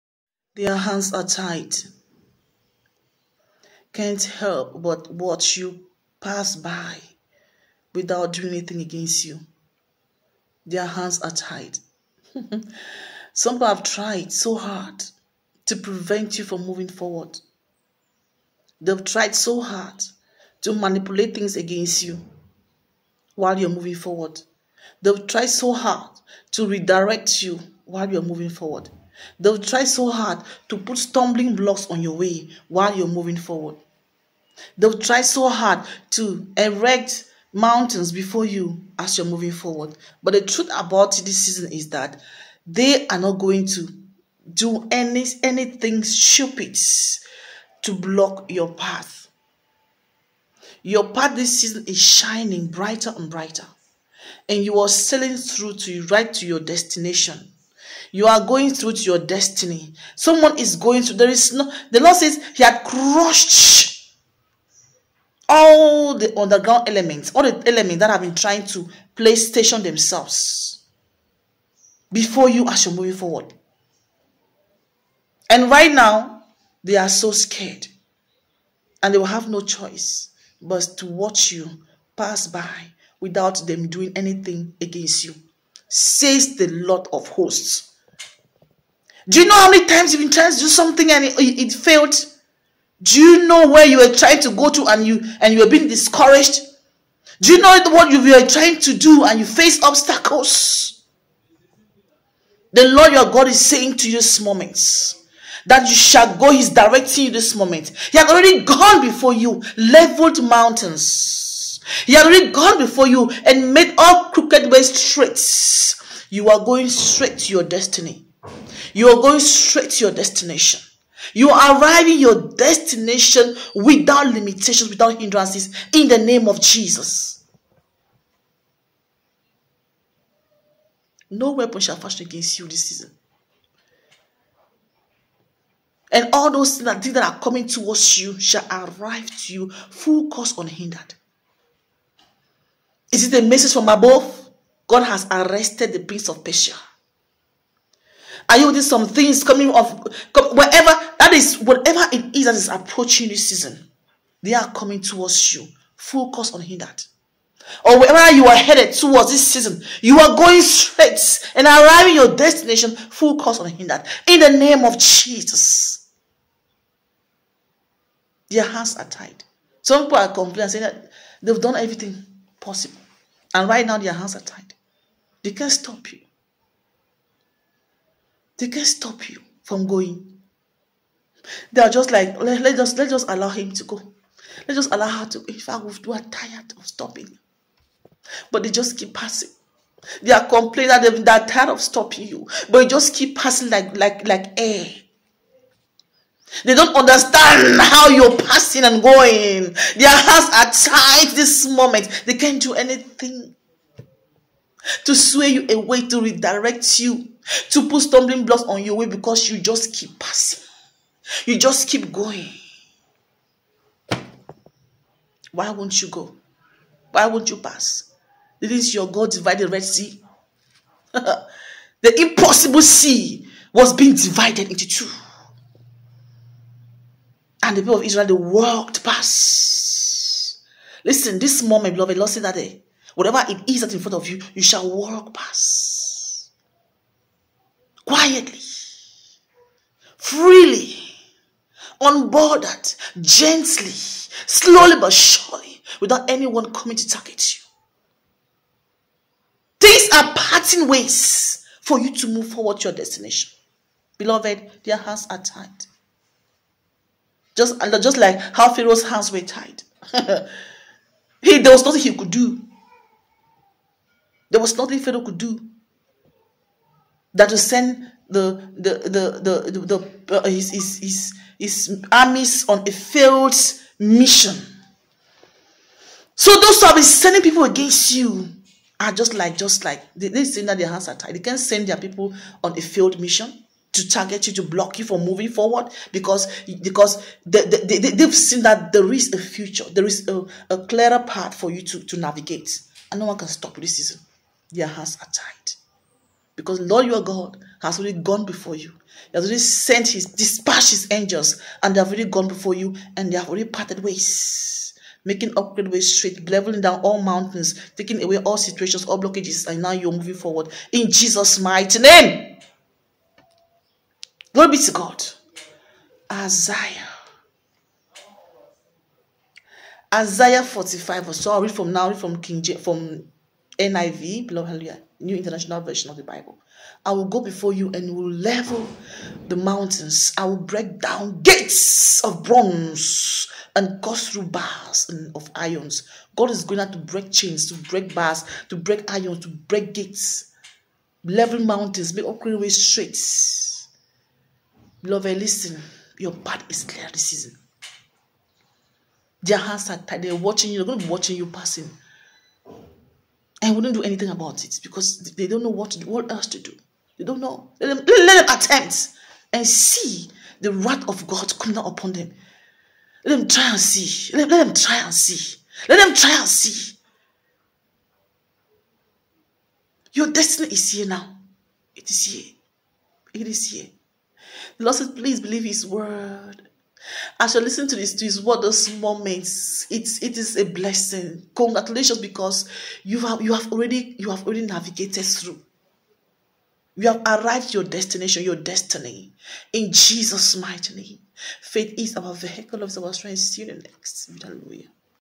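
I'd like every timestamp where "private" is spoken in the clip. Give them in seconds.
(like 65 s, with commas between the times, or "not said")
not said.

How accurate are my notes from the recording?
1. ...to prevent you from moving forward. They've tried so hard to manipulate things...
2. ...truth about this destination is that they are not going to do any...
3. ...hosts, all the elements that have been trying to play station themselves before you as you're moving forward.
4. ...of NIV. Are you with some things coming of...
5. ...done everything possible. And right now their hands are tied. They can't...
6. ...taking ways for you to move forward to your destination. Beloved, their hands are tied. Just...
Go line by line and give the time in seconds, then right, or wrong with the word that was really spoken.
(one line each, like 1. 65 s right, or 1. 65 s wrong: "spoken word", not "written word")
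1. 15 s right
2. 40 s wrong: "season", not "destination"
3. 66 s wrong: "elements", not "hosts"
4. 146 s wrong: "Persia", not "NIV"
5. 171 s right
6. 250 s wrong: "parting", not "taking".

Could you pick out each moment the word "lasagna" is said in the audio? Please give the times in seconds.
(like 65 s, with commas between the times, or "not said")
not said.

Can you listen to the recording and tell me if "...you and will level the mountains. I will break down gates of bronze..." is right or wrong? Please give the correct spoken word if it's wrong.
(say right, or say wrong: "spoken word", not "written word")
right.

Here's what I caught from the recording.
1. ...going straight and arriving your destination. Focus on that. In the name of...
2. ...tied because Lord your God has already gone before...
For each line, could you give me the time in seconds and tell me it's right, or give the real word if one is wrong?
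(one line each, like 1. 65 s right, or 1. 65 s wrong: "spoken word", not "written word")
1. 160 s right
2. 295 s right.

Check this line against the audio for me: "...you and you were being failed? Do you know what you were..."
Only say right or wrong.
wrong.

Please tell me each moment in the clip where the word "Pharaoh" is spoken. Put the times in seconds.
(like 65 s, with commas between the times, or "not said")
258 s, 264 s.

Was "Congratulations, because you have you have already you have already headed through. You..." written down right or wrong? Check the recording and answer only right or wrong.
wrong.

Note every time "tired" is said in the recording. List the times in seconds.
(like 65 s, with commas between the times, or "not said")
186 s, 191 s.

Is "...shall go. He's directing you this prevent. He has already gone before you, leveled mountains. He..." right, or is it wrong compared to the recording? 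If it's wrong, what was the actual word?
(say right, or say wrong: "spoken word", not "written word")
wrong: "moment", not "prevent".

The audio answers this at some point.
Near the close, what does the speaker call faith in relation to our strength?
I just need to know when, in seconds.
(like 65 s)
392 s.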